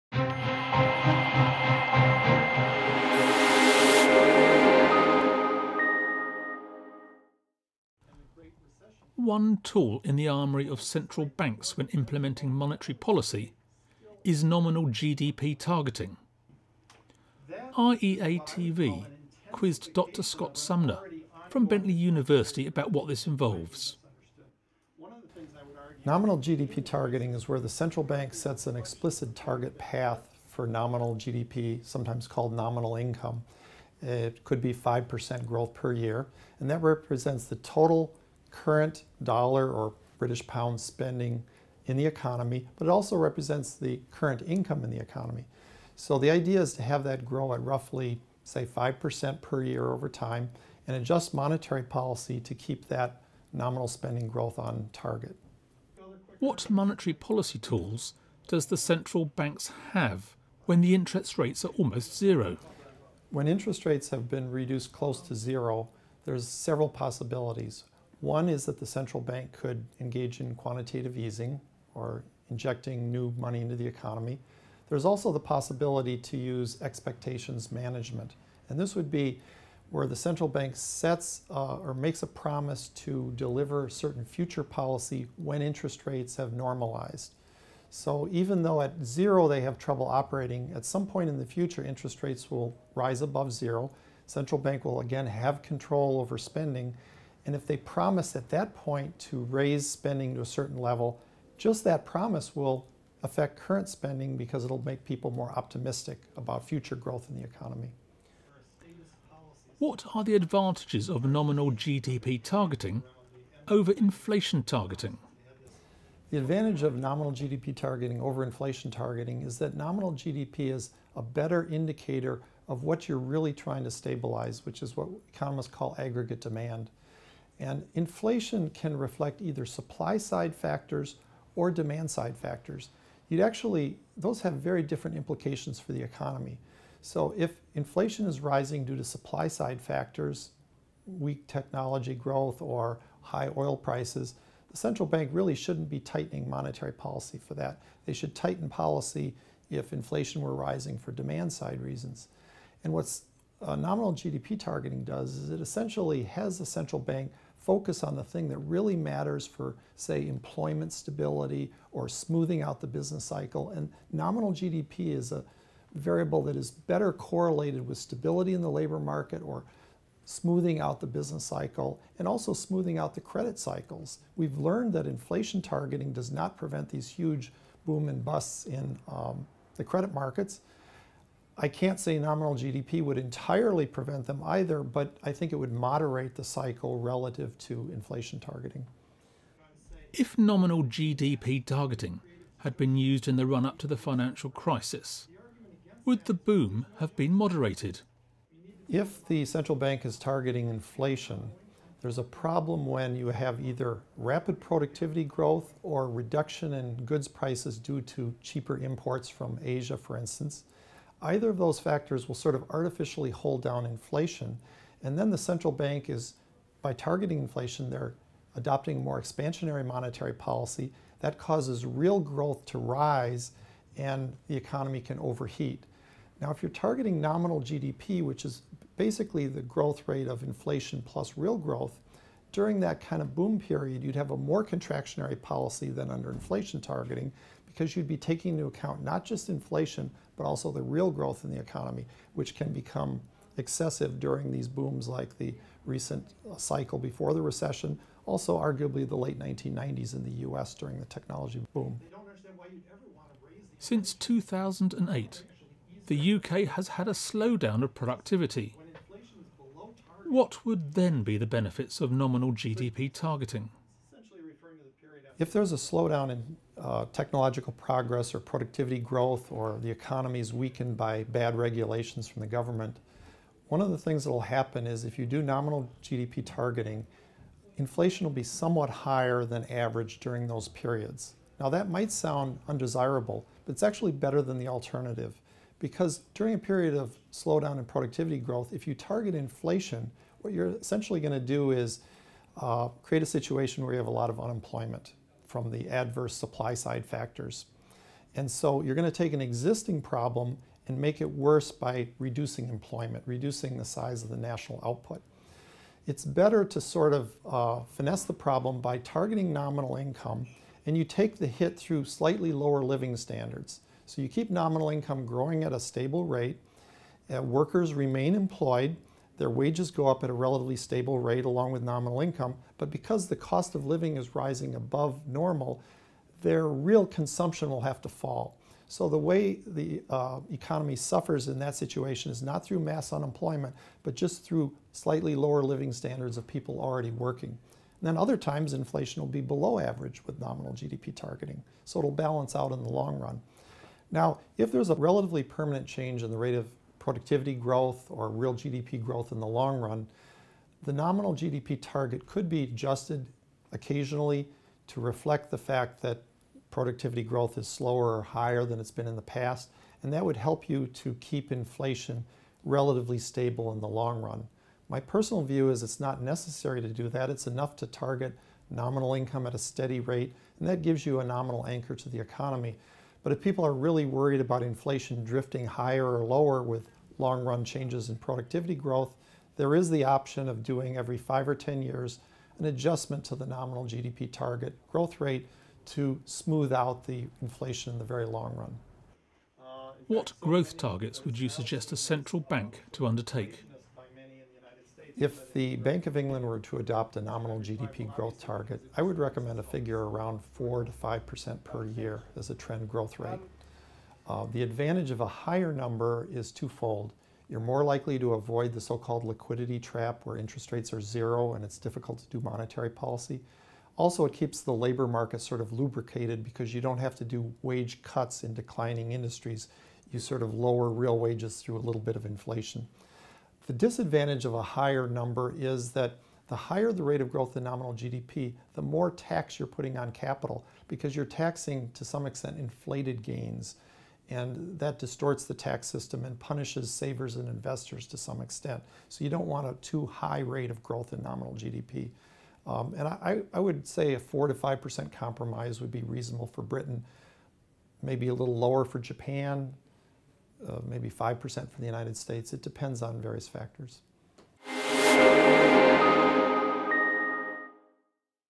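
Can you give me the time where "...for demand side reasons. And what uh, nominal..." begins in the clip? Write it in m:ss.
2:30.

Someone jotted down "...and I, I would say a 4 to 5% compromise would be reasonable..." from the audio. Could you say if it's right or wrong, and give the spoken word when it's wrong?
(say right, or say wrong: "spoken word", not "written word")
right.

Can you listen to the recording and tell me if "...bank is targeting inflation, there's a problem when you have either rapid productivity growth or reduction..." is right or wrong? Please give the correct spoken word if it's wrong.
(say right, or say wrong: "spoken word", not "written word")
right.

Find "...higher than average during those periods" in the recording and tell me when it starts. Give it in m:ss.
4:38.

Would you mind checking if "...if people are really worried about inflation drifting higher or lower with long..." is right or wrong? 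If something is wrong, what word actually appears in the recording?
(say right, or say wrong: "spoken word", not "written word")
right.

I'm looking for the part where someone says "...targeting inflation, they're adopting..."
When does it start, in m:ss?
3:36.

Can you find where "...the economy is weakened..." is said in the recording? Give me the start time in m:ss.
4:29.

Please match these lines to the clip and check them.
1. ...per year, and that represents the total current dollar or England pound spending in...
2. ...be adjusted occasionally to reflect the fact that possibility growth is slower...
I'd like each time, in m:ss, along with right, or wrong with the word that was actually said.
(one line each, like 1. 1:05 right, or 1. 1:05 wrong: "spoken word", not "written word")
1. 0:35 wrong: "British", not "England"
2. 5:52 wrong: "productivity", not "possibility".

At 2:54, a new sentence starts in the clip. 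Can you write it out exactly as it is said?
We've learned that inflation targeting does not prevent these huge boom and busts in um, the credit markets.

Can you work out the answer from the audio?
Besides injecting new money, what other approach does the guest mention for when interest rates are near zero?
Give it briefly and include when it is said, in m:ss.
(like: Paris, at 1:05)
Expectations management, at 1:16.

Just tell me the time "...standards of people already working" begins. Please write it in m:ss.
5:35.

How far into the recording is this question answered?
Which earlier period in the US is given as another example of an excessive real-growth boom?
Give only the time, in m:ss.
4:09.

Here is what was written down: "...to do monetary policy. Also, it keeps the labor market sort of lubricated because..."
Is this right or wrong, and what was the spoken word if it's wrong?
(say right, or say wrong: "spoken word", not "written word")
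right.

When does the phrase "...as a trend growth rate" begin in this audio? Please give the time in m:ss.
6:42.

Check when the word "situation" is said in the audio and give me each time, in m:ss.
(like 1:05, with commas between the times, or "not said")
4:53, 5:31.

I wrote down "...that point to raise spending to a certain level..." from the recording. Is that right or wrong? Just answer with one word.
right.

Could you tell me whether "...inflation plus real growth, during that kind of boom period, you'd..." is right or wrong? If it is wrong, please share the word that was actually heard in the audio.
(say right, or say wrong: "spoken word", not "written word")
right.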